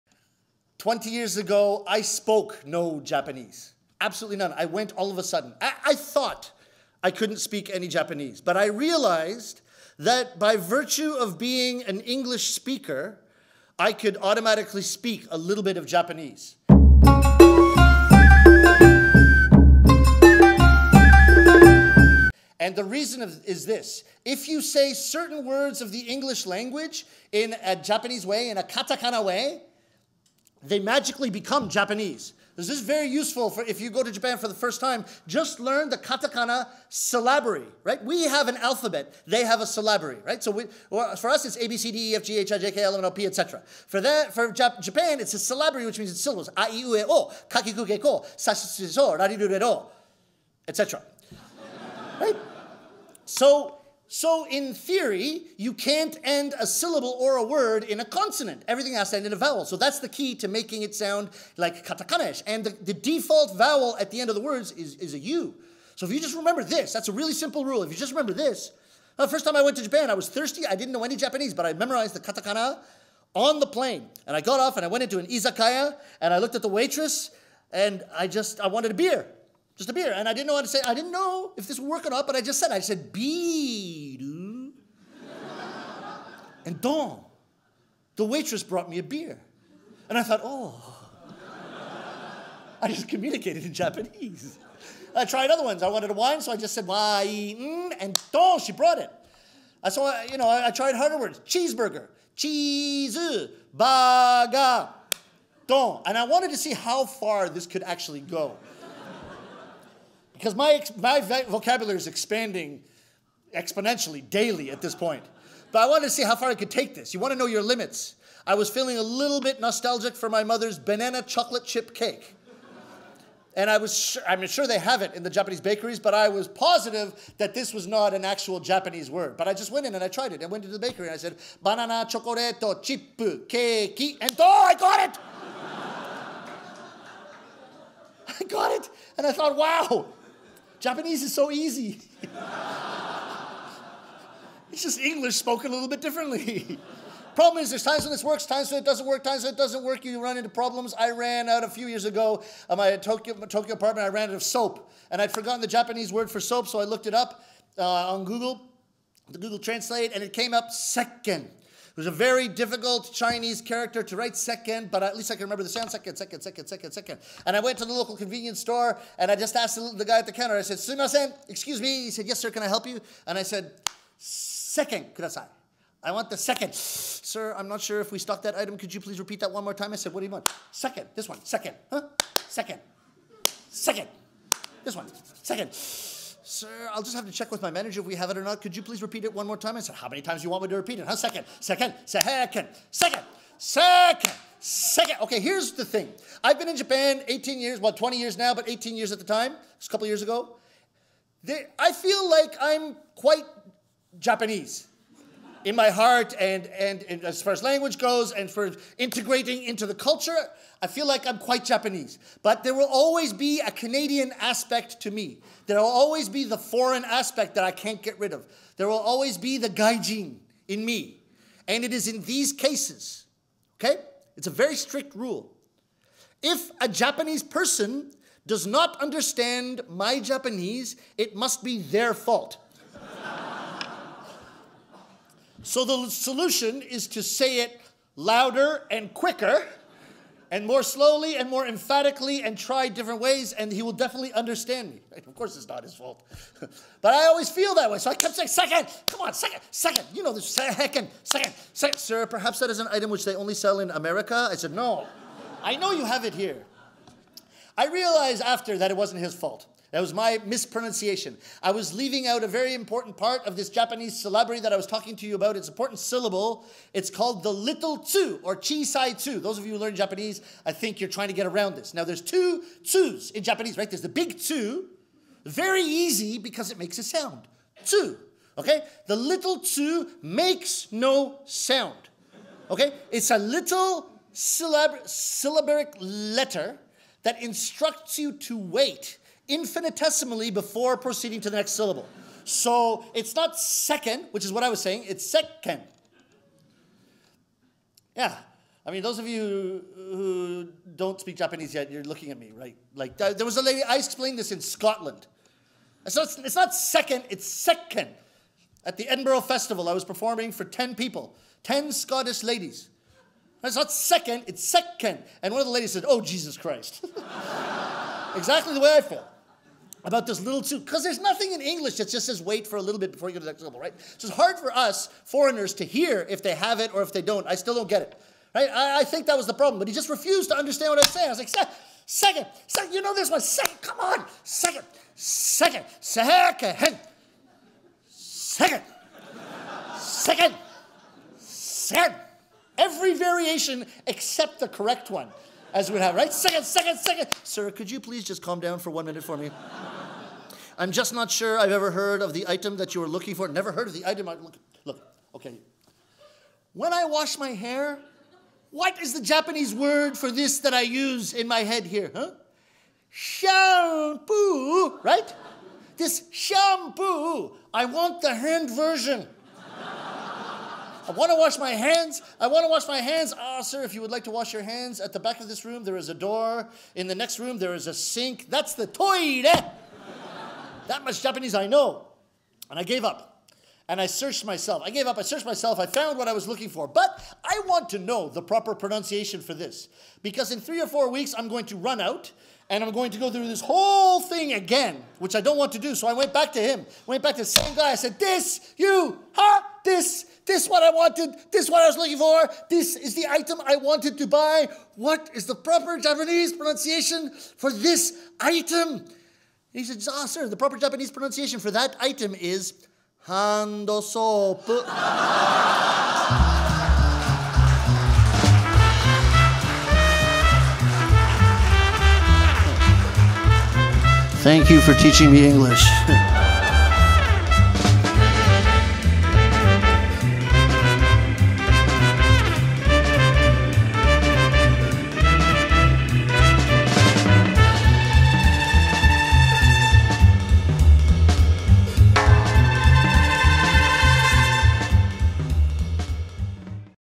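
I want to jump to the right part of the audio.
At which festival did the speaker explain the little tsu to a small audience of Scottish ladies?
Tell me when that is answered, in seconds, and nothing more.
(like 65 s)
309 s.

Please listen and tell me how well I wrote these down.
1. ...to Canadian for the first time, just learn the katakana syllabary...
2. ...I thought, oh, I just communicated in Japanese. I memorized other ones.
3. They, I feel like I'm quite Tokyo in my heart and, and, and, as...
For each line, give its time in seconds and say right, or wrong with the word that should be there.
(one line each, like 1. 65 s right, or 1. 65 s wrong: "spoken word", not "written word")
1. 34 s wrong: "Japan", not "Canadian"
2. 90 s wrong: "tried", not "memorized"
3. 201 s wrong: "Japanese", not "Tokyo".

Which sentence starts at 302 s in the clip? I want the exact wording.
Like, uh, there was a lady, I explained this in Scotland.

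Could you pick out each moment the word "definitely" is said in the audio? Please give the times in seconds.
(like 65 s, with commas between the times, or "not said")
243 s.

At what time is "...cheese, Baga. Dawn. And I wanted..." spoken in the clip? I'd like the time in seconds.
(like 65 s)
102 s.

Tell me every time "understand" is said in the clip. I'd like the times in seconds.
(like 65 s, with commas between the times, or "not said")
228 s, 244 s, 330 s.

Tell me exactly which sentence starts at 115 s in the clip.
But I wanted to see how far I could take this.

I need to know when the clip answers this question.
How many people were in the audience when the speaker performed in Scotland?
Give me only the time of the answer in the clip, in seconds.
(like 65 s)
310 s.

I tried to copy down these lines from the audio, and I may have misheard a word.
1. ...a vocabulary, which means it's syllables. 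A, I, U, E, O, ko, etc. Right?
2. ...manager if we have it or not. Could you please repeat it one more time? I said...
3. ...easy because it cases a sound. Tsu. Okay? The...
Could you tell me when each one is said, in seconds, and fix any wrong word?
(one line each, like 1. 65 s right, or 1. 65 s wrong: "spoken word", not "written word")
1. 45 s wrong: "syllabary", not "vocabulary"
2. 187 s right
3. 275 s wrong: "makes", not "cases".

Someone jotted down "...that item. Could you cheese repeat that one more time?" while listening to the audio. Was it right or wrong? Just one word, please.
wrong.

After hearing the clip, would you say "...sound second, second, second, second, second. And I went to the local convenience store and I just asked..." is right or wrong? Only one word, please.
right.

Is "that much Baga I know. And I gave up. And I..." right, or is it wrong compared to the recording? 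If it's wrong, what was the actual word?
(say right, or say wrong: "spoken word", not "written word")
wrong: "Japanese", not "Baga".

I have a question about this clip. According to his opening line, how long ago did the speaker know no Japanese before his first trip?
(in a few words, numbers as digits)
20 years ago.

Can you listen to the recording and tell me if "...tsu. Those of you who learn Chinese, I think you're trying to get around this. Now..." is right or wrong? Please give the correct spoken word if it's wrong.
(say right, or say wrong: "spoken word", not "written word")
wrong: "Japanese", not "Chinese".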